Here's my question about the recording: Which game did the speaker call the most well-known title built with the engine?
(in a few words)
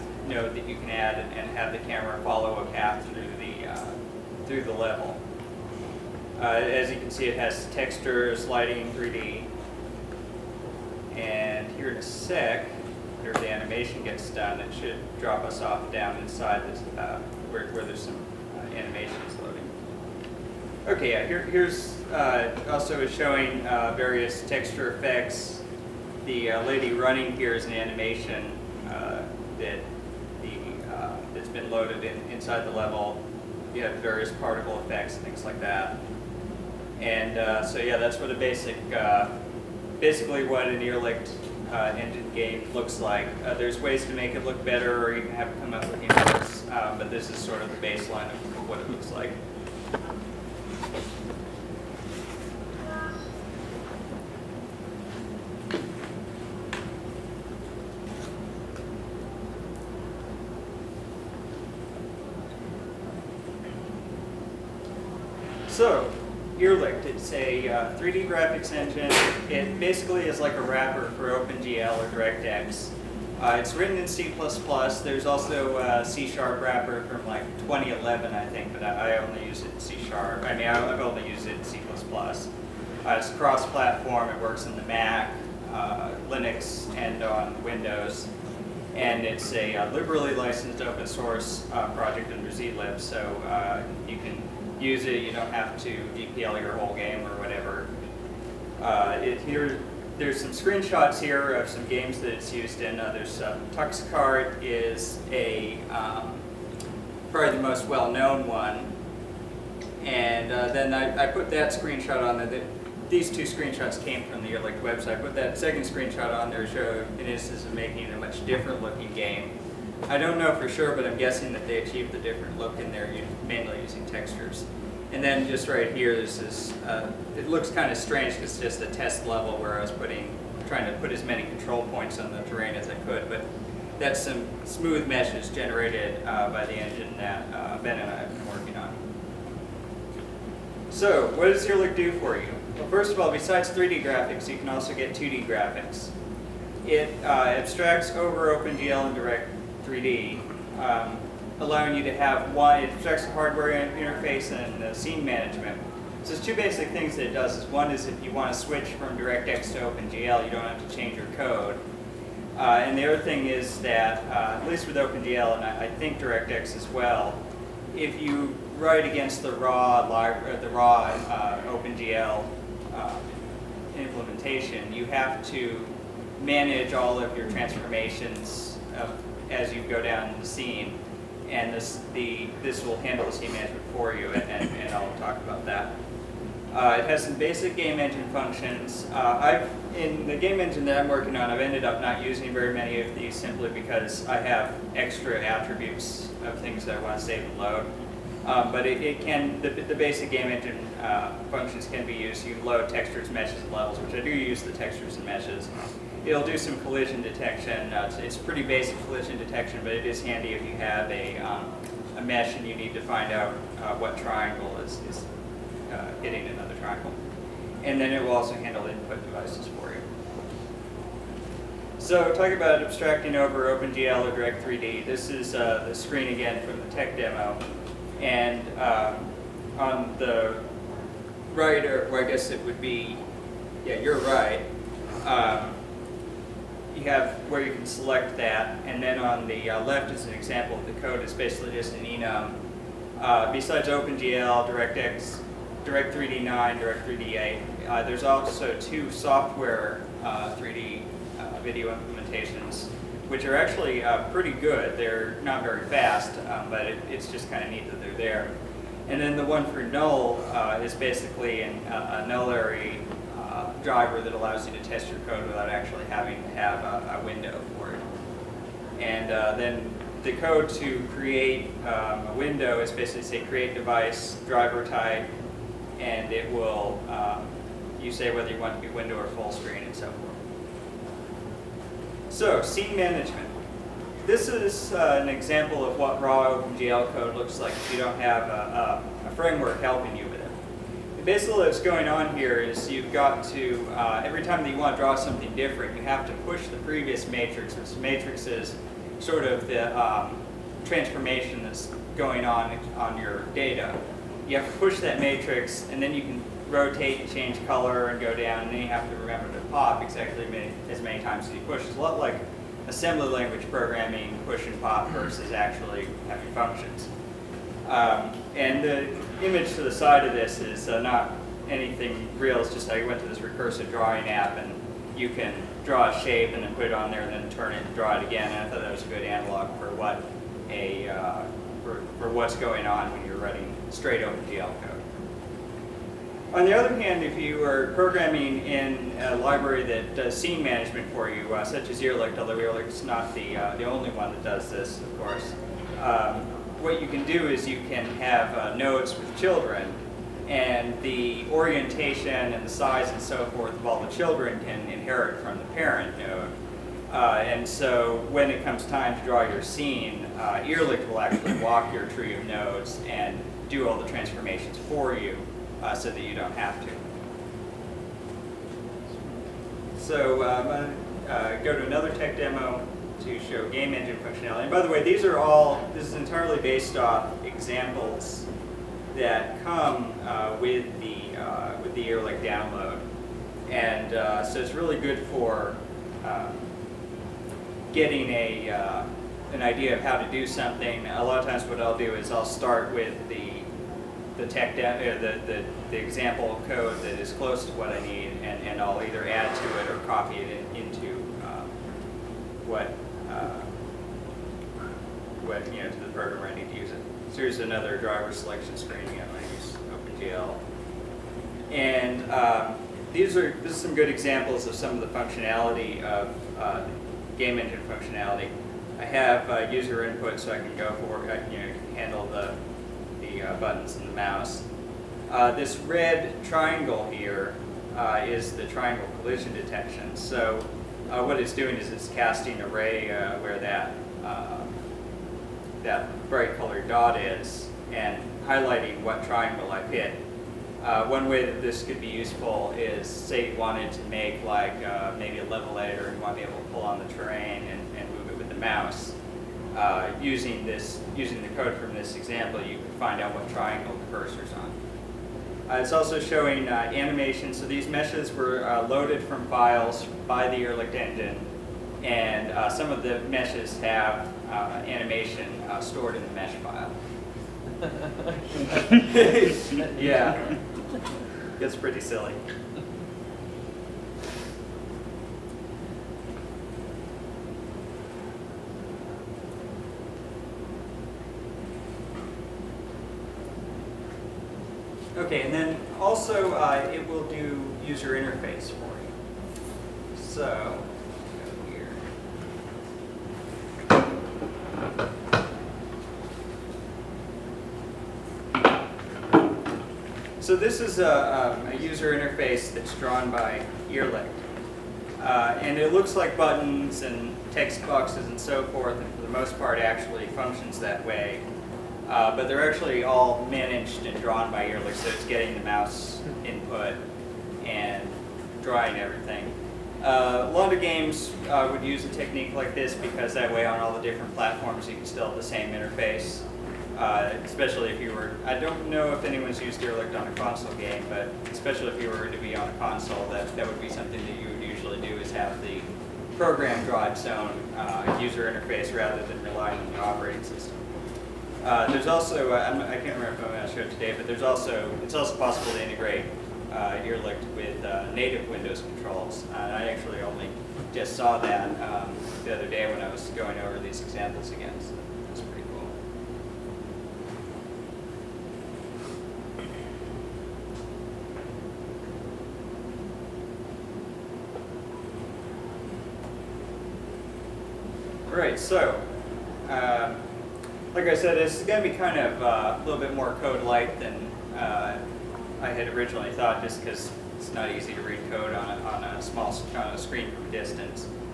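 Tuxicard.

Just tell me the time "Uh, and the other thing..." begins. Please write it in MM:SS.
02:42.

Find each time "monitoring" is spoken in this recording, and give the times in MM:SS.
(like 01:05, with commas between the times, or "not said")
not said.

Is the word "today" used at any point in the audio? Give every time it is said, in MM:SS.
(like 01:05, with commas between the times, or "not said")
09:03.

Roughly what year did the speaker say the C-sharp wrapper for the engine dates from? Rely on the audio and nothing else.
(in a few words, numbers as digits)
2011.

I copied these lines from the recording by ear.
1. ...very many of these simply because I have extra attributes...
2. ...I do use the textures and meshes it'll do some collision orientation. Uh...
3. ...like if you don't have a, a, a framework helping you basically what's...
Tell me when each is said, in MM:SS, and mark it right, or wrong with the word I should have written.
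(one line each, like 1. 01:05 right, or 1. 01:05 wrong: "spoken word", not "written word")
1. 03:12 right
2. 03:24 wrong: "detection", not "orientation"
3. 04:47 right.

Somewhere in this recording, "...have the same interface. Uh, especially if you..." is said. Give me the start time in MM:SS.
08:45.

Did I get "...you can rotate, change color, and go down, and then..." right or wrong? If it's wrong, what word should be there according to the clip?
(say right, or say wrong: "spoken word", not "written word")
right.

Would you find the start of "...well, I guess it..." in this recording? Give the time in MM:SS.
03:52.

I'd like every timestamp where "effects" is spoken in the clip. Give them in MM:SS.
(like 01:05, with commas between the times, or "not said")
00:24, 00:34.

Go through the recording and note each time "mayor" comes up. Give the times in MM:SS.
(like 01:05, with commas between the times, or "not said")
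not said.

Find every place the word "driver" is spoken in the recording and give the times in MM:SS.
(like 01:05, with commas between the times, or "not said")
04:23, 04:34, 06:47.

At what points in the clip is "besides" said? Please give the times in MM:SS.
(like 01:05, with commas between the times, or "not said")
02:23, 04:03.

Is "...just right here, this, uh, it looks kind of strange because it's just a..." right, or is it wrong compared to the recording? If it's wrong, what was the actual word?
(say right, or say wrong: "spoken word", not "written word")
right.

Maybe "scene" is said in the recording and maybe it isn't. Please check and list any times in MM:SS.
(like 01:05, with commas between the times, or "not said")
02:34, 03:00, 04:42, 05:40, 05:59.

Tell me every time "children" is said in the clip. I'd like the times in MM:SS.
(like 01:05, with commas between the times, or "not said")
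05:49, 05:54.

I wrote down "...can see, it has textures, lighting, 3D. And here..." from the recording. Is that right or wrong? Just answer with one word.
right.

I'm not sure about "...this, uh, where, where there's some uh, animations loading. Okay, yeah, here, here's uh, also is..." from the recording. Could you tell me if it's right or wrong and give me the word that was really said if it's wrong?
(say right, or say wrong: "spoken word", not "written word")
right.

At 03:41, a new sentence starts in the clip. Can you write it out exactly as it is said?
So talking about abstracting over OpenGL or Direct 3D, this is uh, the screen again from the tech demo.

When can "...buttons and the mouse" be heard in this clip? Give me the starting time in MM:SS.
07:03.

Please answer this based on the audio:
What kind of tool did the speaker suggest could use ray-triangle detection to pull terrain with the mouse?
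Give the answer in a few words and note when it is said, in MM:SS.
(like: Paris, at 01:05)
A level editor, at 07:25.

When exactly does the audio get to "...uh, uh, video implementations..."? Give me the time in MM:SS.
04:11.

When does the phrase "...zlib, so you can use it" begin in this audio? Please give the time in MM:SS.
01:32.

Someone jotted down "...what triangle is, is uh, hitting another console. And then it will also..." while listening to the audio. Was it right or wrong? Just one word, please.
wrong.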